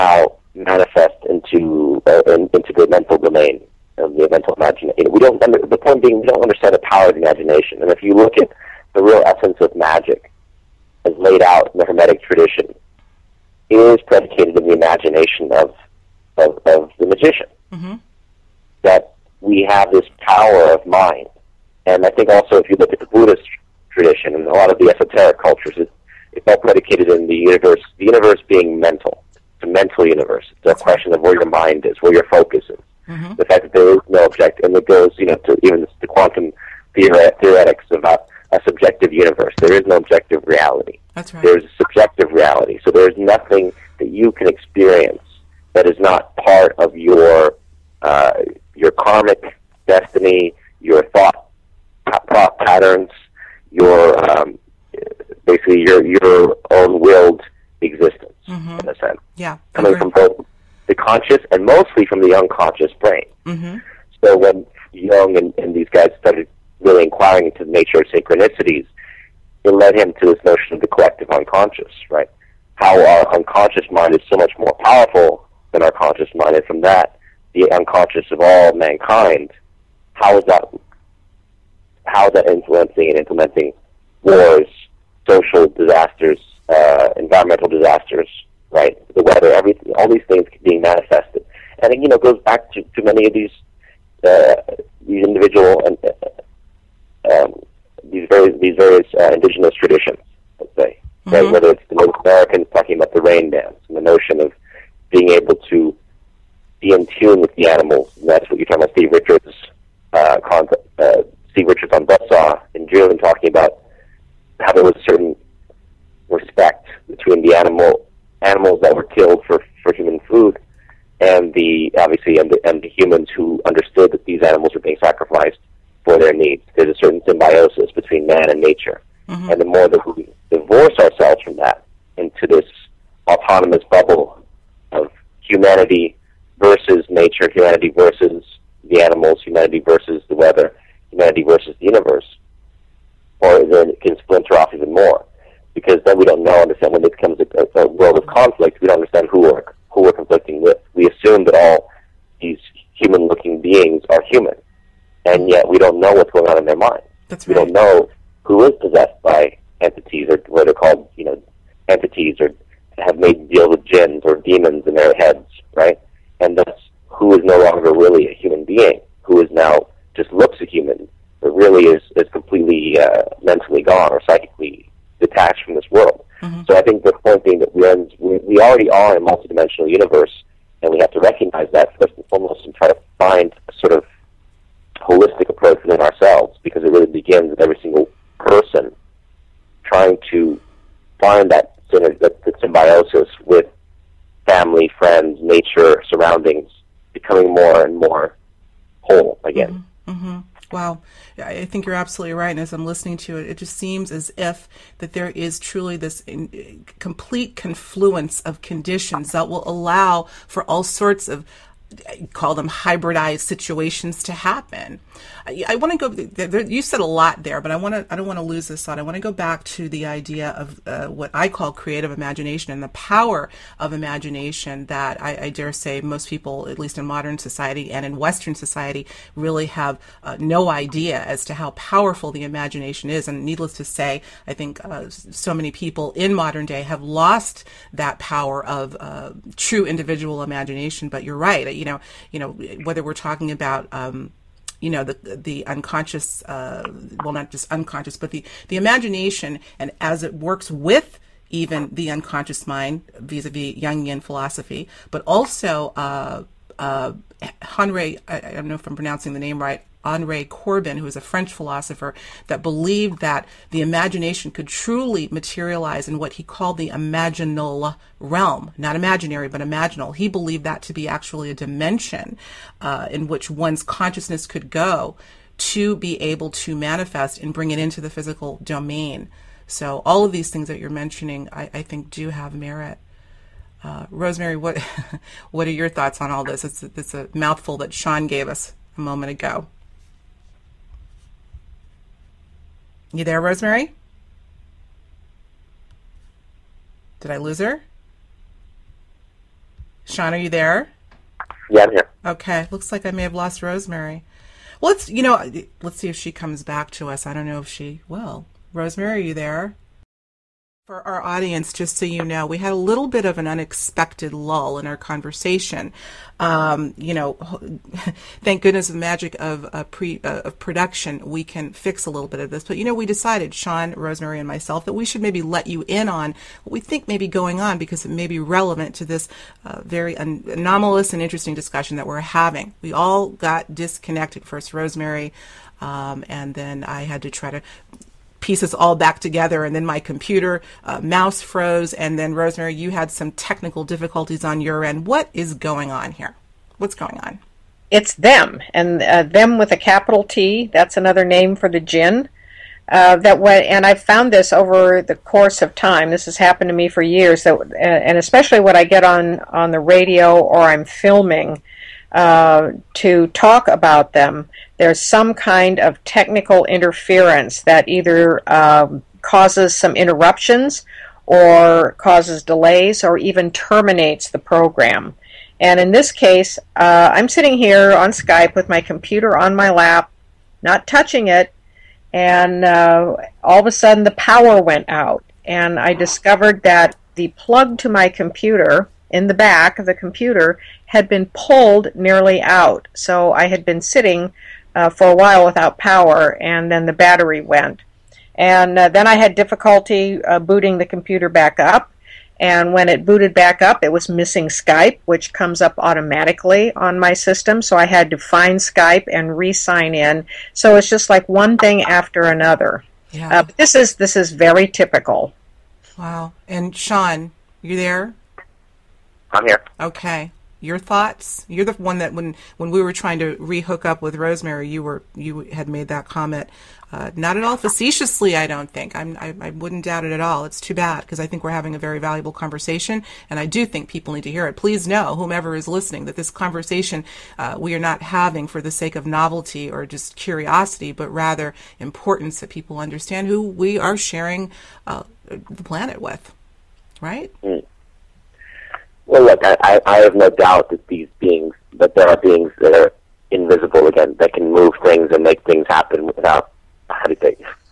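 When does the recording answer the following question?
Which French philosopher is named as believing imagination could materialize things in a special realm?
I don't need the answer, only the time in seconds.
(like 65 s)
260 s.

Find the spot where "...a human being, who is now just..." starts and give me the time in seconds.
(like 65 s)
168 s.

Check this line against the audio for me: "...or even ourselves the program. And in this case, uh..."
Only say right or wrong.
wrong.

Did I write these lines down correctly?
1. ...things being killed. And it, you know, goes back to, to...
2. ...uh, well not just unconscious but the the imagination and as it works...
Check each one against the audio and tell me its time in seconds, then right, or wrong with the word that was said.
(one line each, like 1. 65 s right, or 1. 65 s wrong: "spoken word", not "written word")
1. 90 s wrong: "manifested", not "killed"
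2. 246 s right.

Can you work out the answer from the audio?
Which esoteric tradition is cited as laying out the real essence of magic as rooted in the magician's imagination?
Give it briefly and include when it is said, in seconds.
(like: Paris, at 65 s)
Hermetic tradition, at 11 s.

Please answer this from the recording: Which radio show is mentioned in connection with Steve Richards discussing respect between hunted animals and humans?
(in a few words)
Buzzsaw.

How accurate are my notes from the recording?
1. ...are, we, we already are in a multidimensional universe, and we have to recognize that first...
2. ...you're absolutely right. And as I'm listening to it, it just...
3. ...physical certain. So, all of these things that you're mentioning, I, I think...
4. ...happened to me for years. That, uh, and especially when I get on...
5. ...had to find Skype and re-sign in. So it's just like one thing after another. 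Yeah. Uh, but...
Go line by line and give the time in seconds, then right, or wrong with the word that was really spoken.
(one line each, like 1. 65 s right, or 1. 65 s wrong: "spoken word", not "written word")
1. 177 s right
2. 201 s right
3. 278 s wrong: "domain", not "certain"
4. 356 s right
5. 407 s right.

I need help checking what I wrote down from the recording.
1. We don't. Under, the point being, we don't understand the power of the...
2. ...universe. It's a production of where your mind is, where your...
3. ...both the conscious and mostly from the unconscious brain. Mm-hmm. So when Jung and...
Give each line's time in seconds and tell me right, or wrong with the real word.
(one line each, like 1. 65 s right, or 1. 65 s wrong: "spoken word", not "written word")
1. 5 s right
2. 30 s wrong: "question", not "production"
3. 60 s right.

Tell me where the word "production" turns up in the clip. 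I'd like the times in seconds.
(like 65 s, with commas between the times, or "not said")
320 s.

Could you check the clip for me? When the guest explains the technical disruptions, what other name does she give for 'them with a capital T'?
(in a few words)
the jinn.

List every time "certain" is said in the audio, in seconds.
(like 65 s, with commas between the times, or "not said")
115 s, 126 s.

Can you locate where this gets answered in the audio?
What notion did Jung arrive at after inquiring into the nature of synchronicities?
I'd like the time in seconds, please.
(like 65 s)
70 s.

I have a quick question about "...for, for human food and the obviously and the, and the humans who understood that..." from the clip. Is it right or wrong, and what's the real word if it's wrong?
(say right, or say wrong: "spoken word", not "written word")
right.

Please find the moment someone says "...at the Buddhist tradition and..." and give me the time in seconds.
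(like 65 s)
22 s.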